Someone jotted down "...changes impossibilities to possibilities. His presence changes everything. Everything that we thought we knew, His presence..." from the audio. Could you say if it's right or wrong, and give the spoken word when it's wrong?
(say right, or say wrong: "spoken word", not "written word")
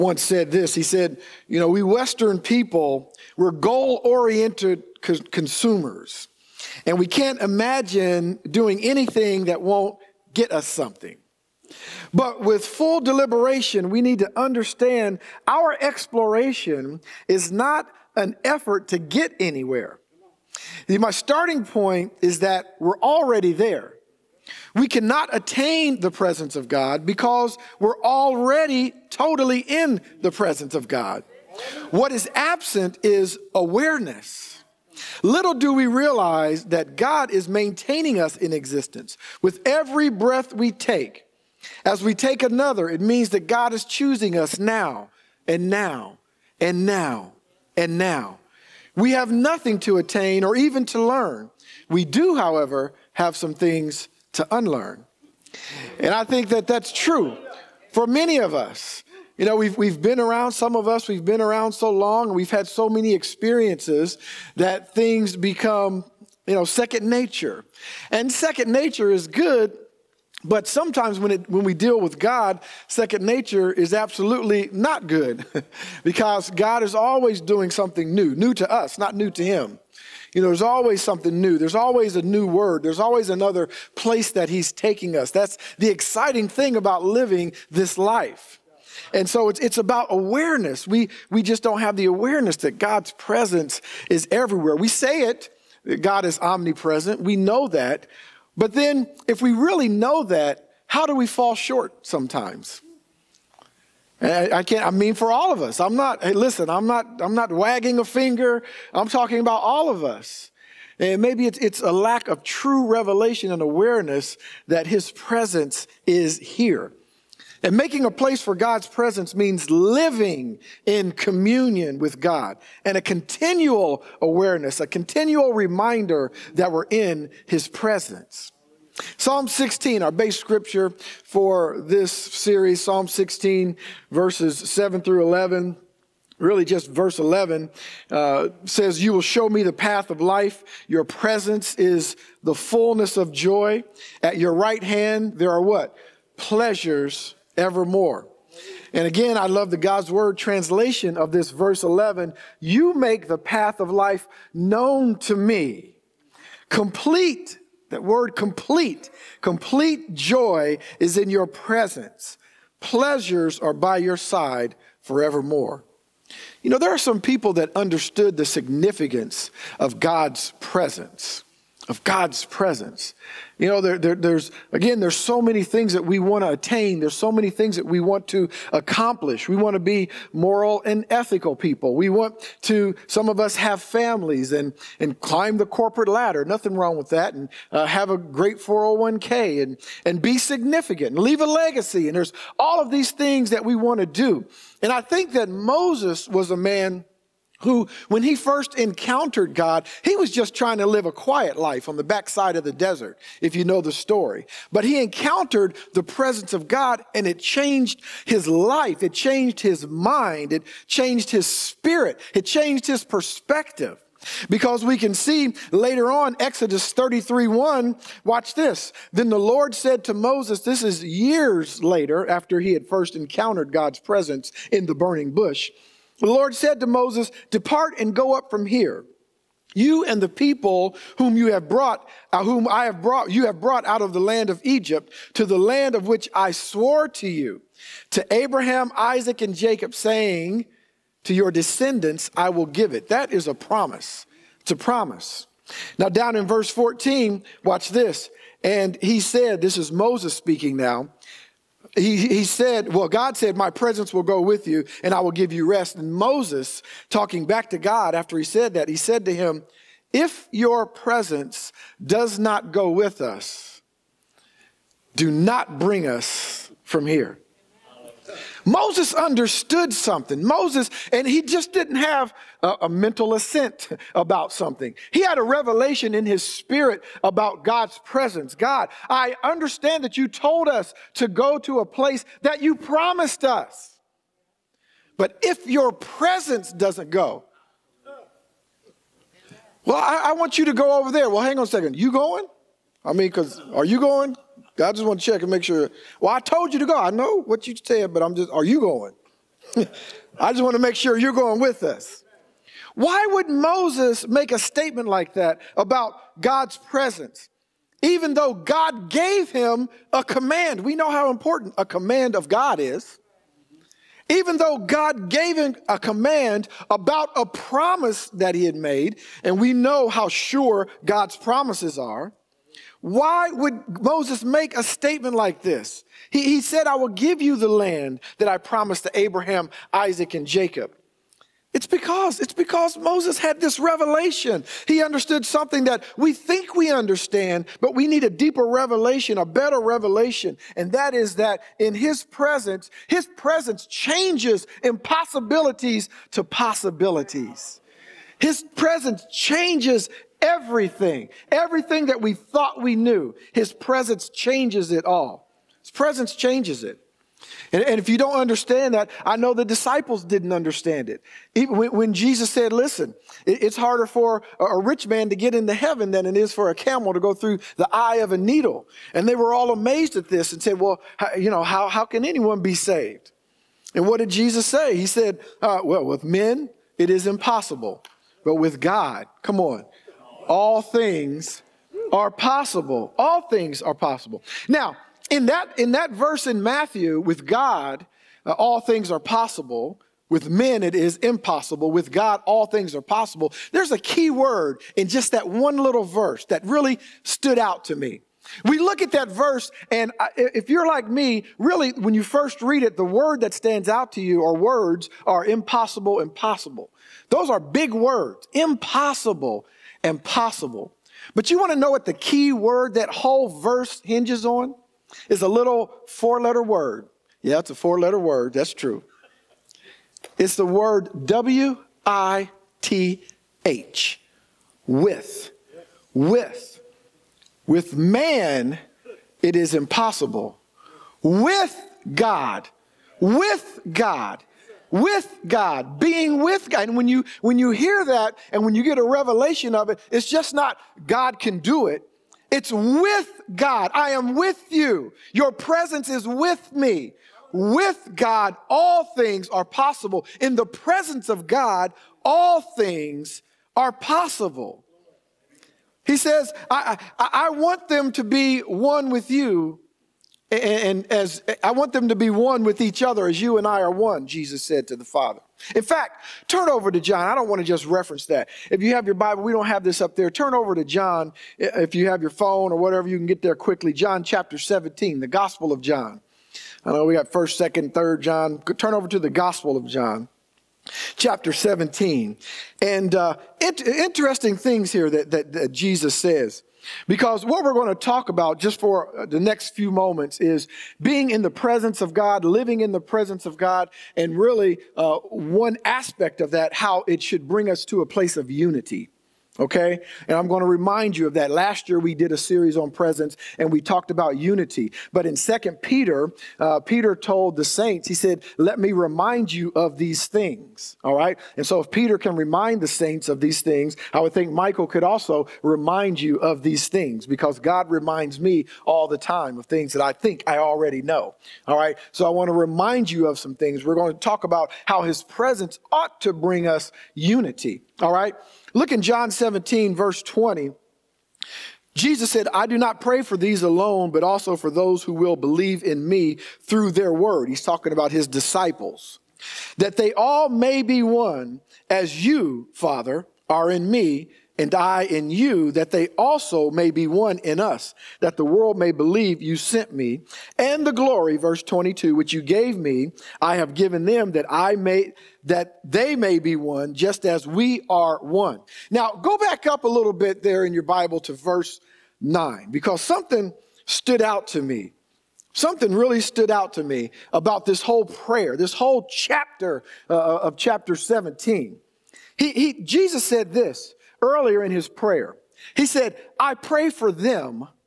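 right.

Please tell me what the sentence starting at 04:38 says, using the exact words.
God, I understand that you told us to go to a place that you promised us.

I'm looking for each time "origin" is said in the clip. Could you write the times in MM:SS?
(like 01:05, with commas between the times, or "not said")
not said.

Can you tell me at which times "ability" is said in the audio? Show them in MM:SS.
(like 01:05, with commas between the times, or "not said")
not said.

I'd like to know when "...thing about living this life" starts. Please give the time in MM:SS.
01:26.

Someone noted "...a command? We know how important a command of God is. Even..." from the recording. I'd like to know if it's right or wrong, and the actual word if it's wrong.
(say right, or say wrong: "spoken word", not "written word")
right.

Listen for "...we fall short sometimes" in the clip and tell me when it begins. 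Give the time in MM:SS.
01:41.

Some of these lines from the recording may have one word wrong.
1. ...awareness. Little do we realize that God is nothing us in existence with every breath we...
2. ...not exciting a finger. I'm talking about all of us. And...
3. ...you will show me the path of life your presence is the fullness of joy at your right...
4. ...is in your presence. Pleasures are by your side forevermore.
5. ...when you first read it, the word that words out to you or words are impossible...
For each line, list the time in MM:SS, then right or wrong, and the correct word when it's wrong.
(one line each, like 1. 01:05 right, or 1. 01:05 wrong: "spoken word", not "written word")
1. 00:33 wrong: "maintaining", not "nothing"
2. 01:47 wrong: "wagging", not "exciting"
3. 02:19 right
4. 02:40 right
5. 06:41 wrong: "stands", not "words".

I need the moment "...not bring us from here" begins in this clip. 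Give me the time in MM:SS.
04:25.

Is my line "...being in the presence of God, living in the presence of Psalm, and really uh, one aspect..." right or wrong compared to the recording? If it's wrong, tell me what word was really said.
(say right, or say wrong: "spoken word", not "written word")
wrong: "God", not "Psalm".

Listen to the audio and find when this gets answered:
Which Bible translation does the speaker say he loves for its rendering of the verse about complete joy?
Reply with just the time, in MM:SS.
02:29.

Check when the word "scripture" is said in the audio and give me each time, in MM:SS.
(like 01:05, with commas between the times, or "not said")
02:10.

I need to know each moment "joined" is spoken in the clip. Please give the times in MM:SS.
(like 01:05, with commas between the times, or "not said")
not said.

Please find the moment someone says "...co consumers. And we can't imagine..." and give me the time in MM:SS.
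00:05.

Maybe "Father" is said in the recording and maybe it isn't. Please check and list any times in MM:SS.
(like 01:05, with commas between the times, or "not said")
07:45, 09:02.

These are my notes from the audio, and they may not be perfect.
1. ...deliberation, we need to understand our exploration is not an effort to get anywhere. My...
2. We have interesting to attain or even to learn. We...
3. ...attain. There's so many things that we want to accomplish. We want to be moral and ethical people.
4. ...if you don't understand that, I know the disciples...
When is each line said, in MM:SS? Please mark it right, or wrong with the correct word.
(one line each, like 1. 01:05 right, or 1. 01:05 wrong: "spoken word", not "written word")
1. 00:13 right
2. 00:48 wrong: "nothing", not "interesting"
3. 02:56 right
4. 05:57 right.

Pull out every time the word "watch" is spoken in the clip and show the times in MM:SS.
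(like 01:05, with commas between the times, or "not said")
03:38, 04:07.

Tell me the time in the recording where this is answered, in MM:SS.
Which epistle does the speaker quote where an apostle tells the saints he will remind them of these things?
08:25.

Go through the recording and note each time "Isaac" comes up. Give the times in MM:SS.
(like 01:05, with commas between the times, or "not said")
03:58, 05:29.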